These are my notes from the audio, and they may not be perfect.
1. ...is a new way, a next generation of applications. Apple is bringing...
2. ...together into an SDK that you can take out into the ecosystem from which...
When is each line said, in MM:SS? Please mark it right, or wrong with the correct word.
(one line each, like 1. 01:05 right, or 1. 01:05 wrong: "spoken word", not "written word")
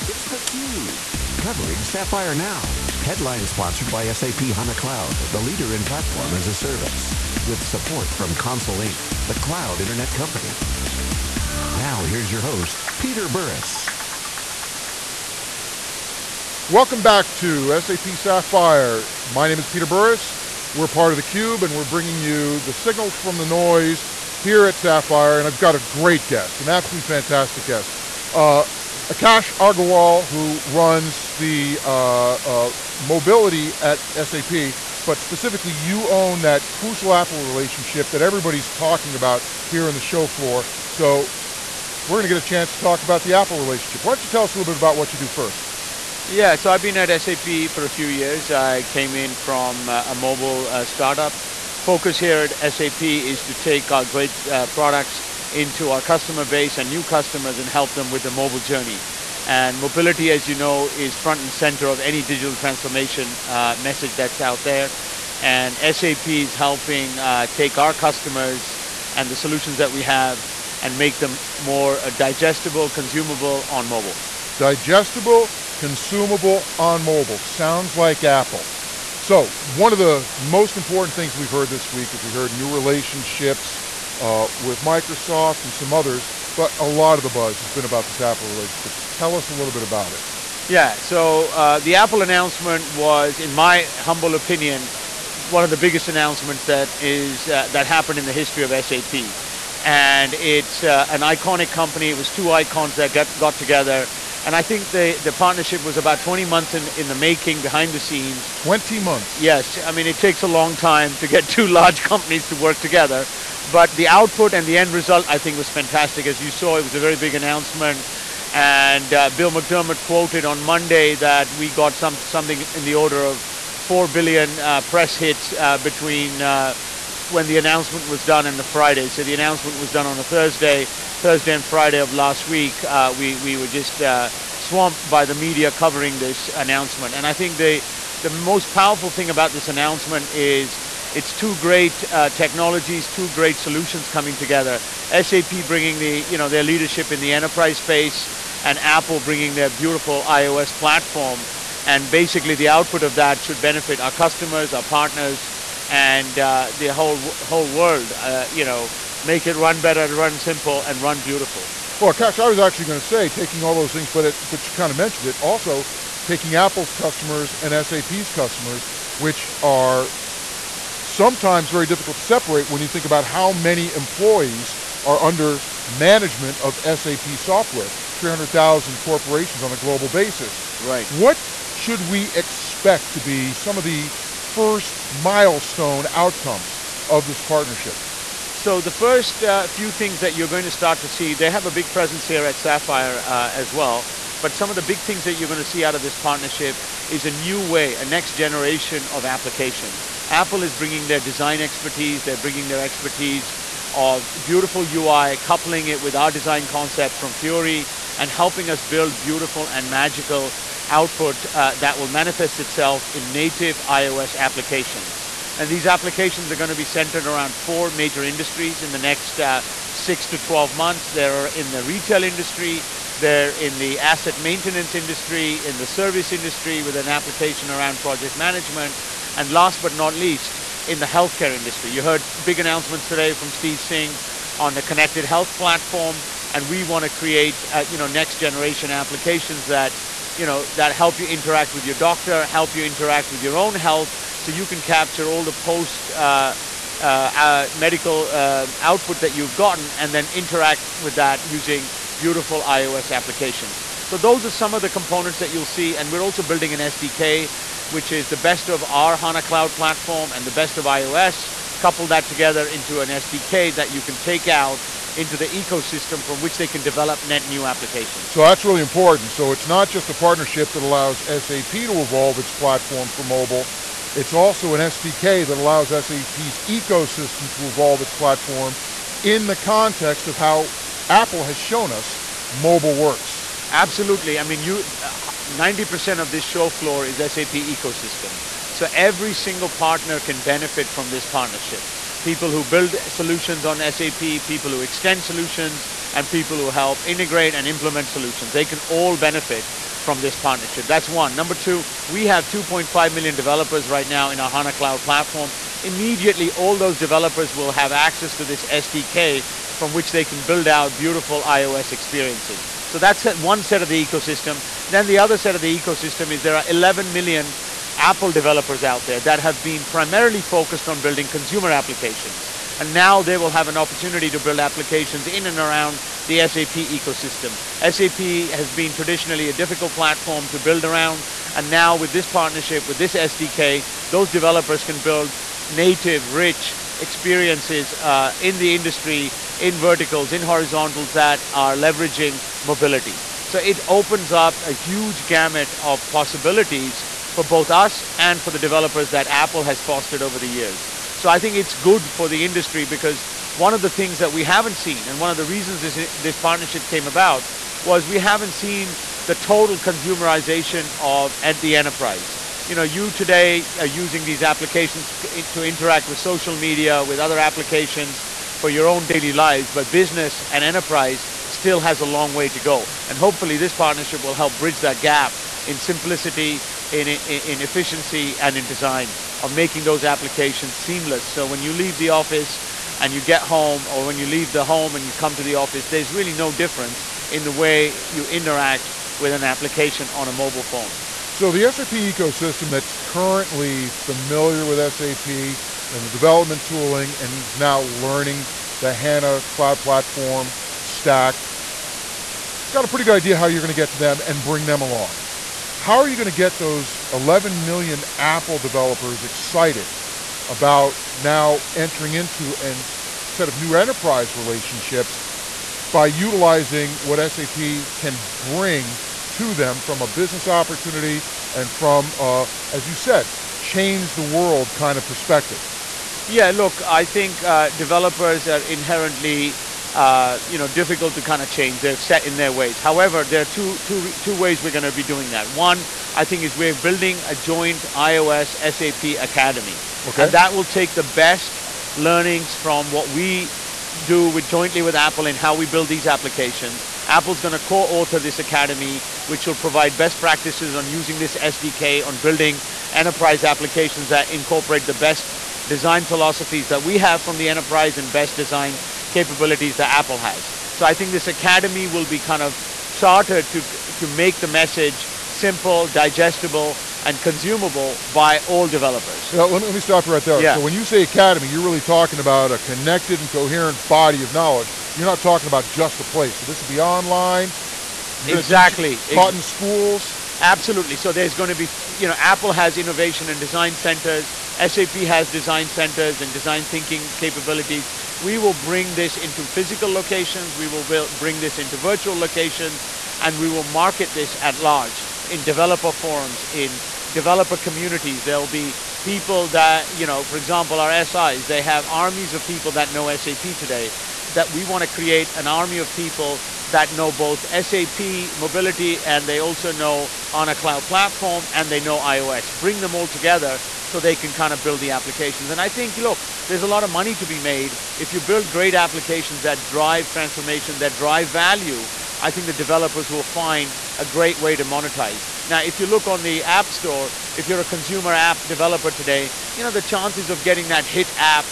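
1. 03:17 right
2. 04:22 right.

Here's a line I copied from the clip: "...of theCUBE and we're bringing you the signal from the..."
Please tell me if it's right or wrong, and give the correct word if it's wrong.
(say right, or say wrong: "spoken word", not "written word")
right.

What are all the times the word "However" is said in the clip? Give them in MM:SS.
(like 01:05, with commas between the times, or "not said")
07:12.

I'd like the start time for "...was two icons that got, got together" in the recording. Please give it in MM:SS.
01:42.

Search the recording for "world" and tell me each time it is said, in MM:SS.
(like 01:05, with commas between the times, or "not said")
02:37, 07:04.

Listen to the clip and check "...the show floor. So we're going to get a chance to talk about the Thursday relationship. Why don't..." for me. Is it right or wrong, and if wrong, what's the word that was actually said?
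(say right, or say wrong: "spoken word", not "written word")
wrong: "Apple", not "Thursday".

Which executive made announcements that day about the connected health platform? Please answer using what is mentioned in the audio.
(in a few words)
Steve Singh.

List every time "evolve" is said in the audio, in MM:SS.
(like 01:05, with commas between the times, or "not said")
04:32, 04:37.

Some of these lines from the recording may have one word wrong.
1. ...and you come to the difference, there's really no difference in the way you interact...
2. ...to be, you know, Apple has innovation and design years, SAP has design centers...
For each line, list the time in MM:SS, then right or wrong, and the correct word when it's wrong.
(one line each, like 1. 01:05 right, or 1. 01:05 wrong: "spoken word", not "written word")
1. 06:24 wrong: "office", not "difference"
2. 08:01 wrong: "centers", not "years".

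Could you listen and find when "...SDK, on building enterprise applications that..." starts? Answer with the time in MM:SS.
07:31.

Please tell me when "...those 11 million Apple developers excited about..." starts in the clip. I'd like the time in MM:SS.
06:46.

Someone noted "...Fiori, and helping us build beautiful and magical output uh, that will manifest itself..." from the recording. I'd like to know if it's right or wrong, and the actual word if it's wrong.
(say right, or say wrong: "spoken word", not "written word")
right.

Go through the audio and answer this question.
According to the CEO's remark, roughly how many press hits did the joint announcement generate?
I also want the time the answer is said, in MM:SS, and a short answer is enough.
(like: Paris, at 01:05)
4 billion, at 02:03.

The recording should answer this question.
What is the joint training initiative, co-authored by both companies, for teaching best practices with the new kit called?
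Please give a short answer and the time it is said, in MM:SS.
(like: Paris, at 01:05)
iOS SAP Academy, at 07:17.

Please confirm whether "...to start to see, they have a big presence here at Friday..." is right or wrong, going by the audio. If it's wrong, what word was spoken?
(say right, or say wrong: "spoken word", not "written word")
wrong: "Sapphire", not "Friday".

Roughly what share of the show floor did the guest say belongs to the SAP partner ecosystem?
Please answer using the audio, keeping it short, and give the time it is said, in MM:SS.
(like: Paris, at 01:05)
90%, at 04:44.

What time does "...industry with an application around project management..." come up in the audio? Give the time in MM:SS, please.
03:46.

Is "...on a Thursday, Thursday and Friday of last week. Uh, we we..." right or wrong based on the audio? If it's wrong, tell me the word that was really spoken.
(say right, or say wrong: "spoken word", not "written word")
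right.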